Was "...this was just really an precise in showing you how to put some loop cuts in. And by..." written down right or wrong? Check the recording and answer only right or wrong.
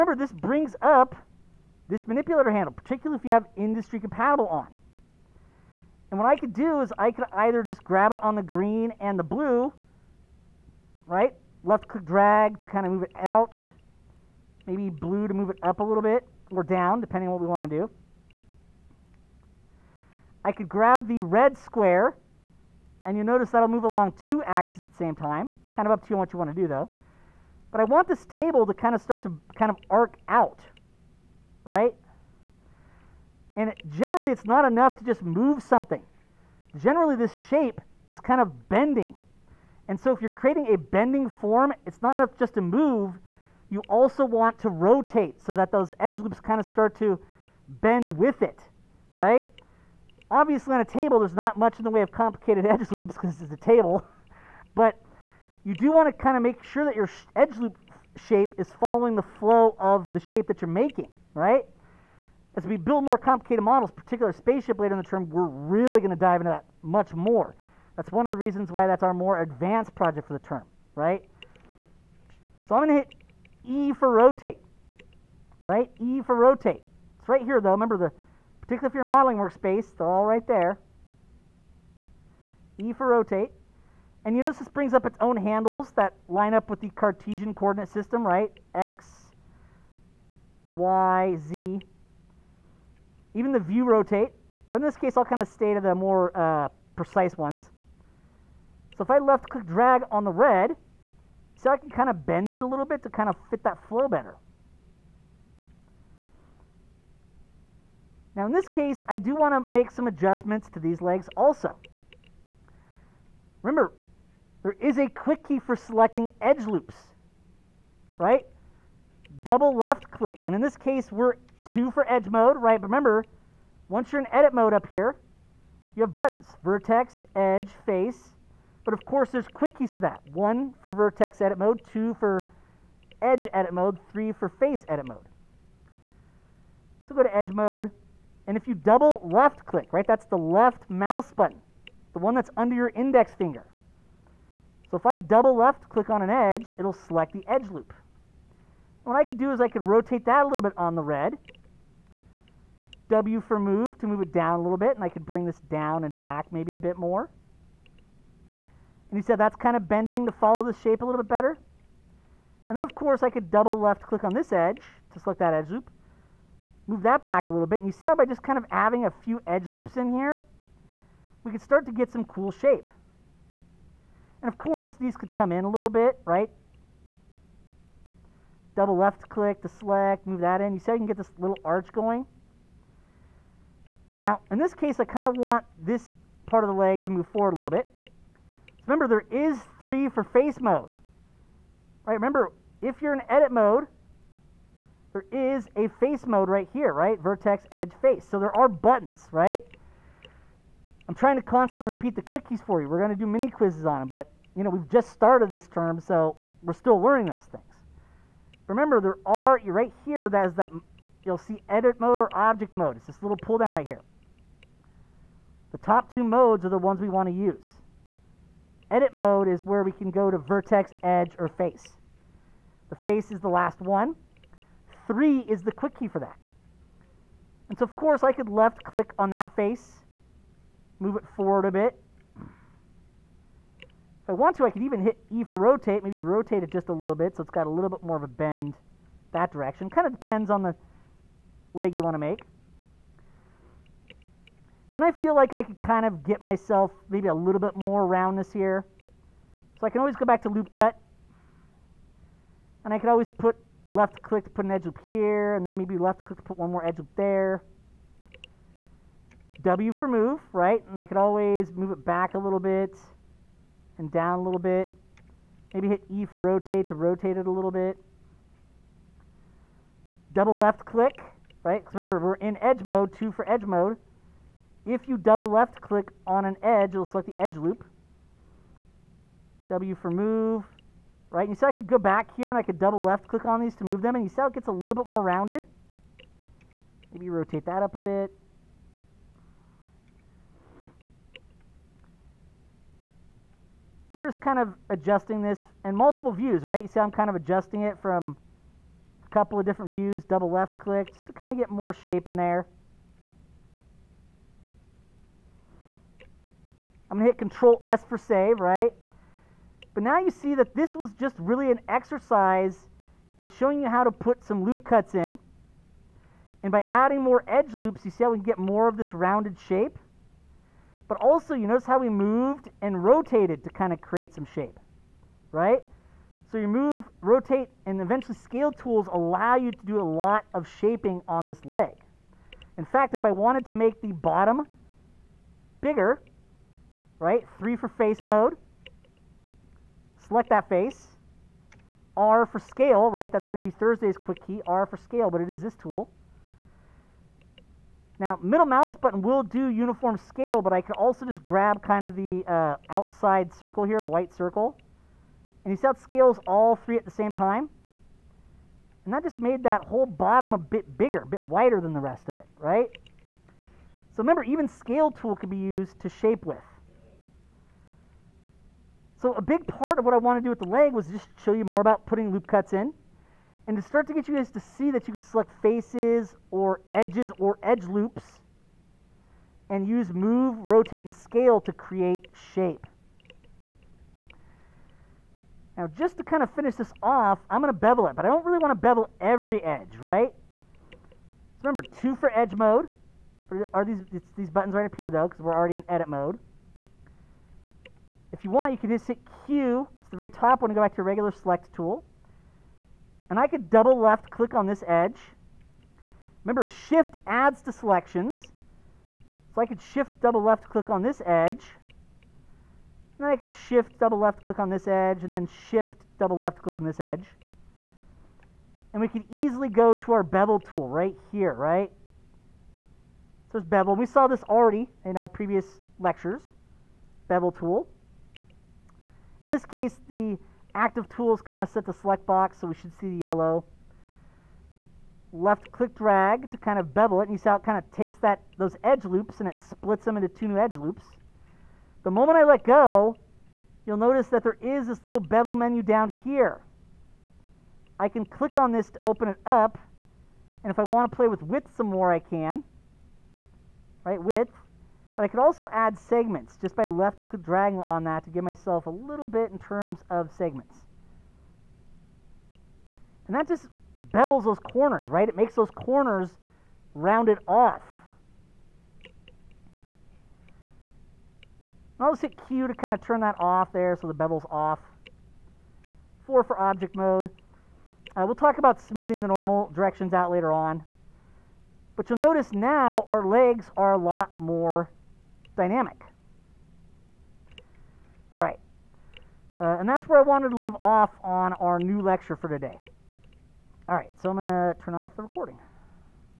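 wrong.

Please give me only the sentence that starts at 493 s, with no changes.
All right, so I'm going to turn off the recording.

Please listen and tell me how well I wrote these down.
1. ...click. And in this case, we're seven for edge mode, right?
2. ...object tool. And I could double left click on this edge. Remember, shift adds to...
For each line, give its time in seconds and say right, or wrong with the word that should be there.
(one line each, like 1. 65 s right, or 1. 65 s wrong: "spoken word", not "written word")
1. 120 s wrong: "two", not "seven"
2. 401 s wrong: "select", not "object".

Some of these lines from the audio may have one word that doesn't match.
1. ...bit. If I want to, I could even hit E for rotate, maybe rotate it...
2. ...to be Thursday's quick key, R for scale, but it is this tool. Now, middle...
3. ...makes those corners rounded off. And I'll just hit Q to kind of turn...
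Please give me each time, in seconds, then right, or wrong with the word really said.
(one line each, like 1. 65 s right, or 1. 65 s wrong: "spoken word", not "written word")
1. 231 s right
2. 343 s right
3. 465 s right.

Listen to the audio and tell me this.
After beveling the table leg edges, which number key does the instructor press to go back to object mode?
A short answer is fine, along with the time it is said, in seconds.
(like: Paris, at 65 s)
4, at 476 s.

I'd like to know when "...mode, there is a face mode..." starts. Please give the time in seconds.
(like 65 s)
193 s.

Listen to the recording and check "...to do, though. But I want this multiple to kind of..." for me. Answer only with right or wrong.
wrong.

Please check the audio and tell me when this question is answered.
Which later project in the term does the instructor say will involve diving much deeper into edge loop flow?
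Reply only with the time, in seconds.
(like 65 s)
64 s.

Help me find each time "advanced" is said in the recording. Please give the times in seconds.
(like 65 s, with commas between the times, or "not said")
69 s.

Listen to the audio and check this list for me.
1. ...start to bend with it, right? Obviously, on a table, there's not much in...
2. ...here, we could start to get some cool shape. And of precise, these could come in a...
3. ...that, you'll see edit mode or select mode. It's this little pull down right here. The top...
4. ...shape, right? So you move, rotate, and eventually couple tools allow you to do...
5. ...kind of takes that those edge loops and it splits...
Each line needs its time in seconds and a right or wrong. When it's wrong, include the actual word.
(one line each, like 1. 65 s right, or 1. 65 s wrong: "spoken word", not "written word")
1. 46 s right
2. 170 s wrong: "course", not "precise"
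3. 210 s wrong: "object", not "select"
4. 324 s wrong: "scale", not "couple"
5. 437 s right.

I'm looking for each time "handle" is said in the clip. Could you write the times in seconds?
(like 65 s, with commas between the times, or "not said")
2 s, 85 s.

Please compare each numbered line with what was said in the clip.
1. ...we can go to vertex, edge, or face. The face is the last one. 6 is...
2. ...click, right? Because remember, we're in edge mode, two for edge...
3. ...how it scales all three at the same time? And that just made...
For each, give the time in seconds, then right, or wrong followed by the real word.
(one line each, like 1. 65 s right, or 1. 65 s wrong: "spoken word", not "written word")
1. 219 s wrong: "3", not "6"
2. 270 s right
3. 355 s right.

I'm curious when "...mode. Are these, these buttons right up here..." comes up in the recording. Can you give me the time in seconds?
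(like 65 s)
392 s.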